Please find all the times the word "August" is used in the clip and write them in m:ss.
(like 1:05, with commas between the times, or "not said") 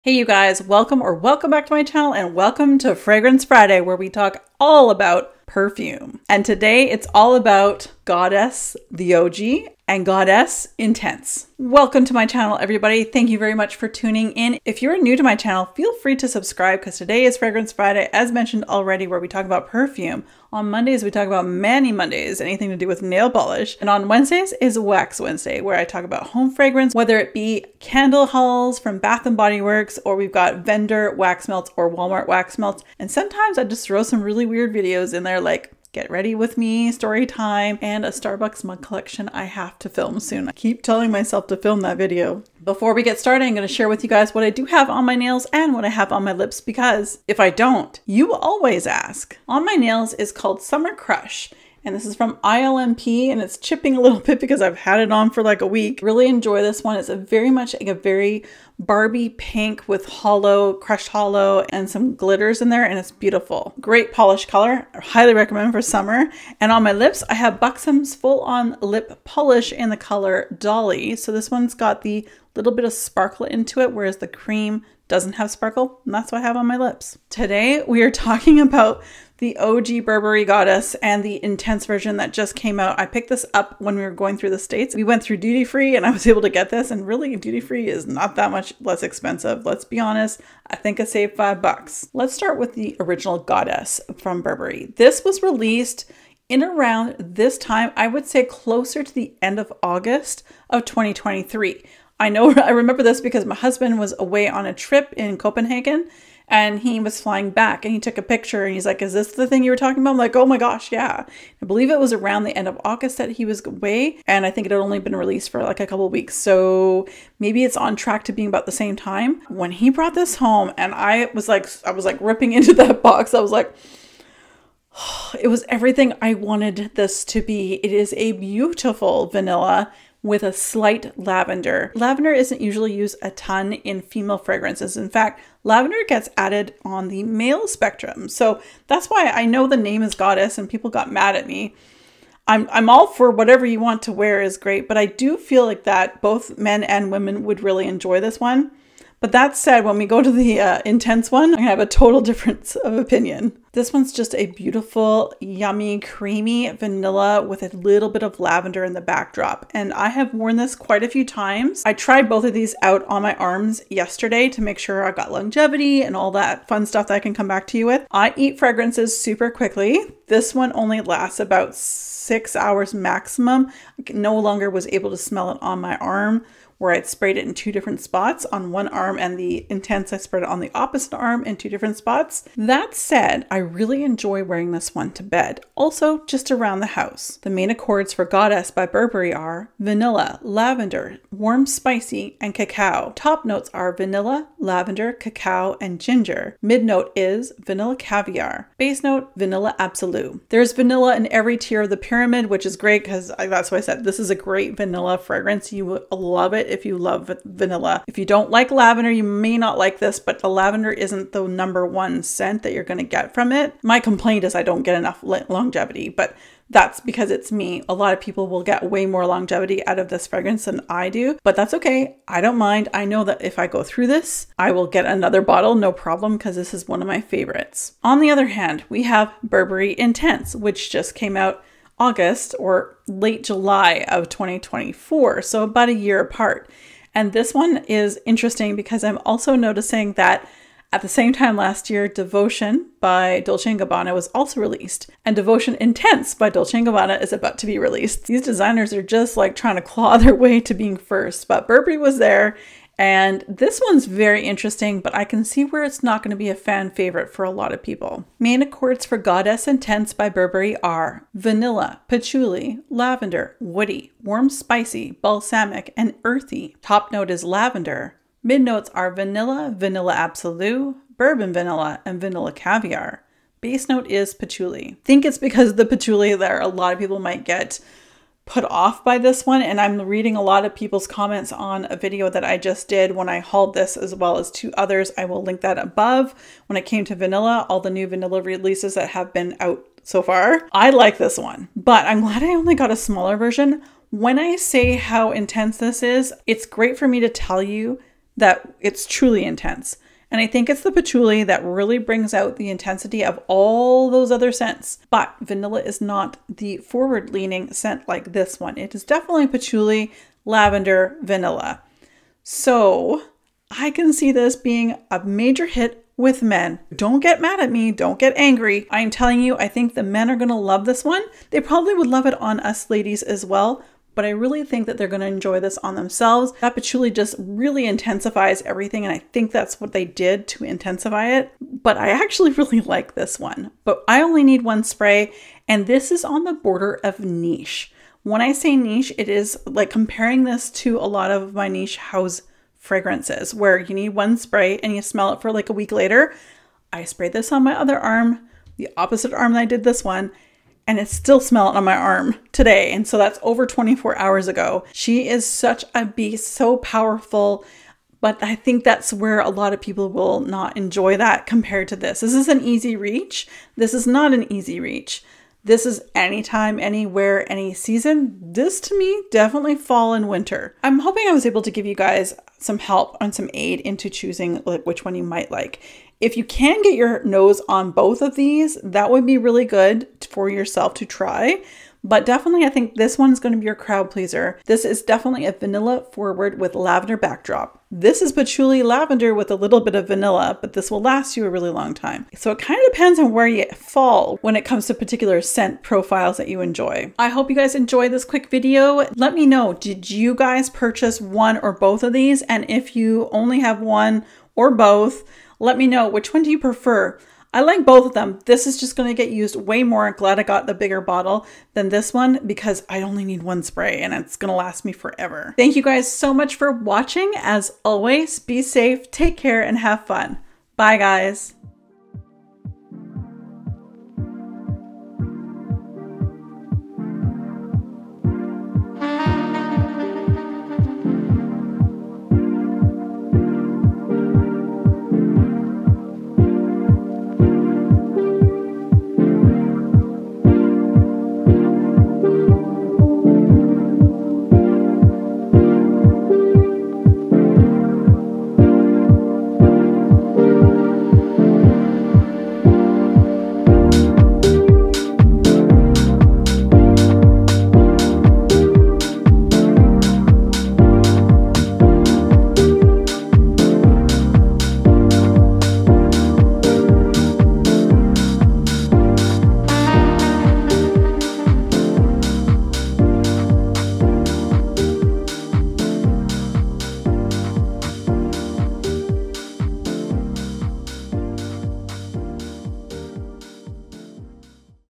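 1:39, 1:52, 3:52.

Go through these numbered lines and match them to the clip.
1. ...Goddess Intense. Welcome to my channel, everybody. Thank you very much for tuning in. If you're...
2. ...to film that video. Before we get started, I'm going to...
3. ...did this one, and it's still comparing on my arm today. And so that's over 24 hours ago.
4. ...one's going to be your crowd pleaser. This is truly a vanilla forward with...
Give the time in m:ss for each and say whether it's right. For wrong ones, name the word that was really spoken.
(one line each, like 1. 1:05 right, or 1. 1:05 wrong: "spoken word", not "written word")
1. 0:10 right
2. 0:41 right
3. 5:49 wrong: "smelling", not "comparing"
4. 6:23 wrong: "definitely", not "truly".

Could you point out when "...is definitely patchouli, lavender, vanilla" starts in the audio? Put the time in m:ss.
5:08.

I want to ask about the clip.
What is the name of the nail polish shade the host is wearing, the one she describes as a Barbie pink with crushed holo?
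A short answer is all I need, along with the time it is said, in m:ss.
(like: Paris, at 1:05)
Summer Crush, at 0:50.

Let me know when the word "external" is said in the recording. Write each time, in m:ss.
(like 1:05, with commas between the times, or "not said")
not said.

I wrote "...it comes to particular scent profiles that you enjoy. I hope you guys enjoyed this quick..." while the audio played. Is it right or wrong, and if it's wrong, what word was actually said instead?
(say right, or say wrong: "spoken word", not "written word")
right.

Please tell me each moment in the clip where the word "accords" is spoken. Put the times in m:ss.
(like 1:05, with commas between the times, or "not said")
3:07, 4:18.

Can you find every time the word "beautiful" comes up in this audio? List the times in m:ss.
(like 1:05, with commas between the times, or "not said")
1:03, 2:08, 2:34.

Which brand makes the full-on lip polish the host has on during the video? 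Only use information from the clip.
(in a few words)
Buxom.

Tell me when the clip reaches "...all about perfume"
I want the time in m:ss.
0:04.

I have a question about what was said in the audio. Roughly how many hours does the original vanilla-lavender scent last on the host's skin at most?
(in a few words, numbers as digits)
6.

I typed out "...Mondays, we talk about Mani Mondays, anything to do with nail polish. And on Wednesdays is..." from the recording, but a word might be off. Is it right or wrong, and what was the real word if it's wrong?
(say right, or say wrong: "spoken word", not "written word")
right.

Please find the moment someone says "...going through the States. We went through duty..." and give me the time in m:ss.
1:24.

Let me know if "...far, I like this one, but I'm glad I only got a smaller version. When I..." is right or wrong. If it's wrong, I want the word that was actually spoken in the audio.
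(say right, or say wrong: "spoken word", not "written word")
right.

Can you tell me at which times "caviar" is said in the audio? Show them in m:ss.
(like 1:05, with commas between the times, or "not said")
3:17, 4:32.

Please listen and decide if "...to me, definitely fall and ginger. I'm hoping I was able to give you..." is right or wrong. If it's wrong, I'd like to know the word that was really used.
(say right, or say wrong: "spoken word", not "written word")
wrong: "winter", not "ginger".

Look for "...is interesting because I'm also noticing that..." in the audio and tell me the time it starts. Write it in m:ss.
3:57.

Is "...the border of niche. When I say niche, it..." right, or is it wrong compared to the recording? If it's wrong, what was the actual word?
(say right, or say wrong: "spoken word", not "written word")
right.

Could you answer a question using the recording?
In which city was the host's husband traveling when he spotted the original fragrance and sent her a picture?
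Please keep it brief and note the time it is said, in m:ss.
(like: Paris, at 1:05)
Copenhagen, at 1:45.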